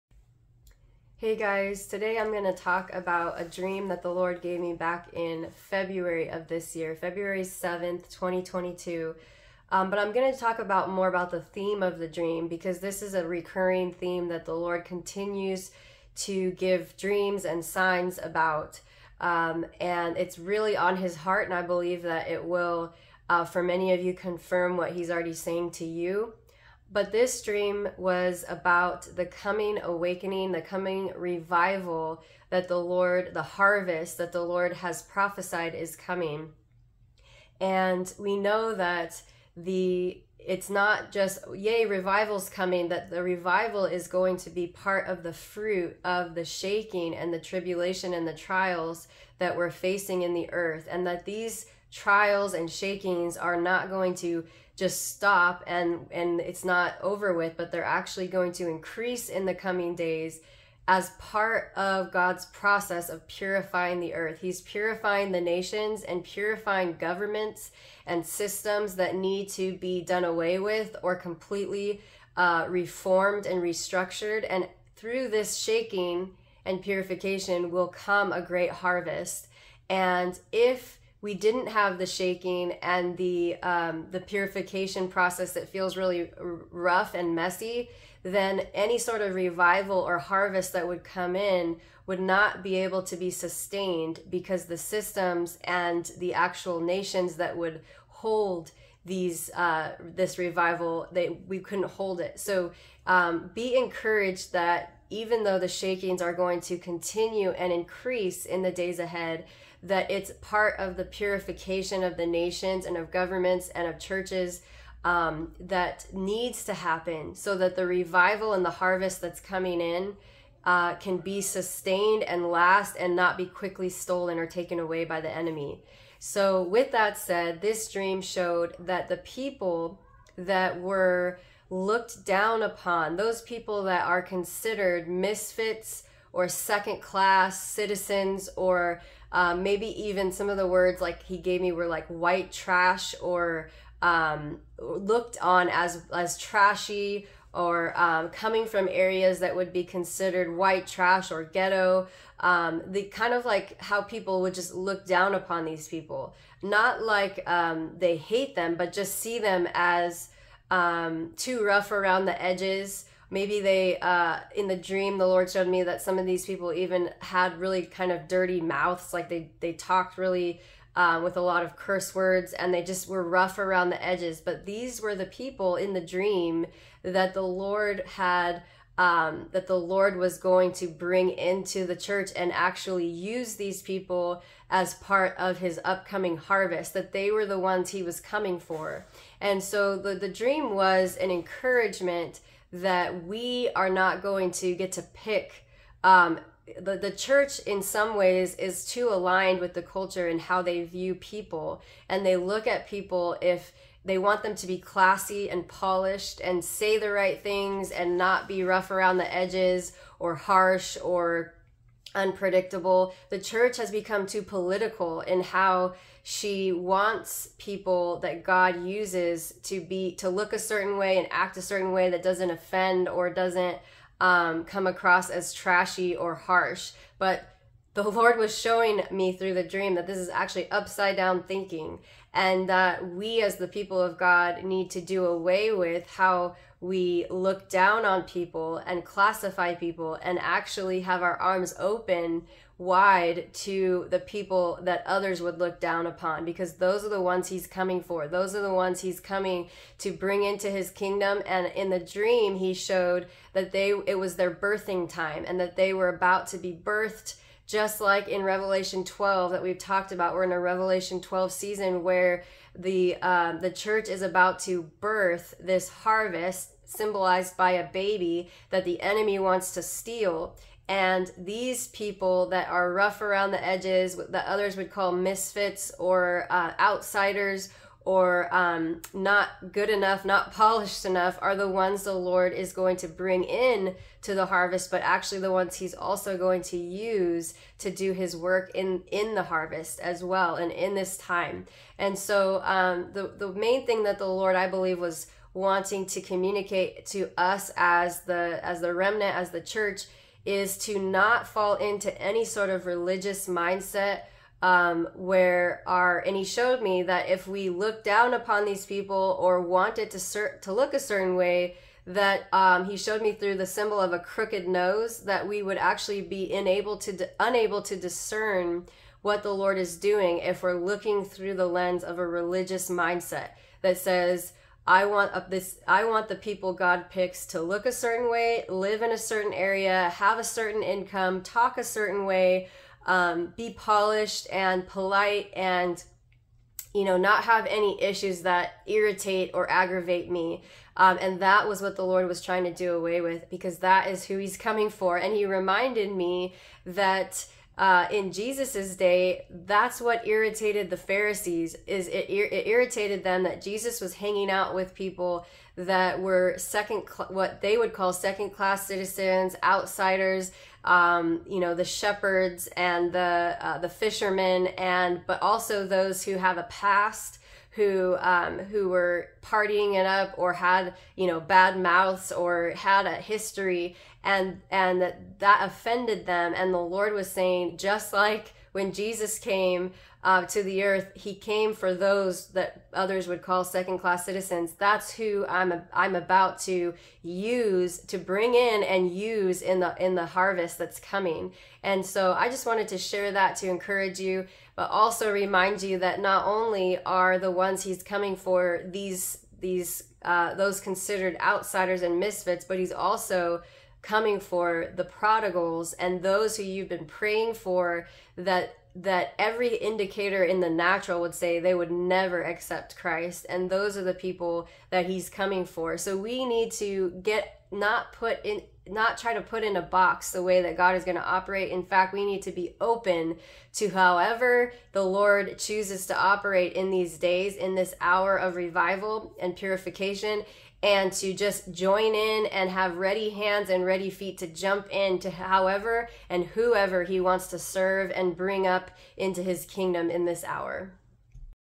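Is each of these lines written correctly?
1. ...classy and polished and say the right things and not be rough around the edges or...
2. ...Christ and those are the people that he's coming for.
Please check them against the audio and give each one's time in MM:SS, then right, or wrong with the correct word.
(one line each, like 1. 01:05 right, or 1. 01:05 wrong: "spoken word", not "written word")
1. 03:24 right
2. 06:52 right.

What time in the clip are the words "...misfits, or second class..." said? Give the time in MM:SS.
02:15.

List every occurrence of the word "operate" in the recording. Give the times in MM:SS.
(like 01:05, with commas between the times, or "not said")
07:01, 07:06.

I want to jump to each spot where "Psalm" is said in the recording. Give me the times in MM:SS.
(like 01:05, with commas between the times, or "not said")
not said.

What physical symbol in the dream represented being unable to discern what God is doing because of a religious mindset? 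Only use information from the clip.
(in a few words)
A crooked nose.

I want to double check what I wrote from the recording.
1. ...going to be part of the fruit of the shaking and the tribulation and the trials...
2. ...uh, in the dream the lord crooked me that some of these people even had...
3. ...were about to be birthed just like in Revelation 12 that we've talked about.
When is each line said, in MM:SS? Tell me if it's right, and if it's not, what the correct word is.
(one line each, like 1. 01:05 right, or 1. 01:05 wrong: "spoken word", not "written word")
1. 00:44 right
2. 02:43 wrong: "showed", not "crooked"
3. 04:15 right.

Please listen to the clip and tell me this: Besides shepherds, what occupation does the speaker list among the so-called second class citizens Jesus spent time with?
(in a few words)
Fishermen.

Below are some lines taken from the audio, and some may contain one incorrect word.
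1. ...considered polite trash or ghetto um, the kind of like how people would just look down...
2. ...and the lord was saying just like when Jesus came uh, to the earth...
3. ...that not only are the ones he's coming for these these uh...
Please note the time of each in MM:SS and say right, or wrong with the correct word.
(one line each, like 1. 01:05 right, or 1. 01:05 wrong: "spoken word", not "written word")
1. 02:29 wrong: "white", not "polite"
2. 06:16 right
3. 06:35 right.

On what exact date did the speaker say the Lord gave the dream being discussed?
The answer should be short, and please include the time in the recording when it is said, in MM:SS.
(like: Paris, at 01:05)
February 7th, 2022, at 00:06.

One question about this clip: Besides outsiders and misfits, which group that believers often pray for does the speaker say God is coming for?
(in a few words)
The prodigals.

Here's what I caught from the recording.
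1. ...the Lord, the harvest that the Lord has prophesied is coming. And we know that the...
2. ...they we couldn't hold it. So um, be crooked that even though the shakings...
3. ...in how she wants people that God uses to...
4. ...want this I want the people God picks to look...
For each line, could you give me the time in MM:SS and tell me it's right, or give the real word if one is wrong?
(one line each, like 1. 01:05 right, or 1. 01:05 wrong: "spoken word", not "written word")
1. 00:32 right
2. 01:41 wrong: "encouraged", not "crooked"
3. 03:35 right
4. 05:25 right.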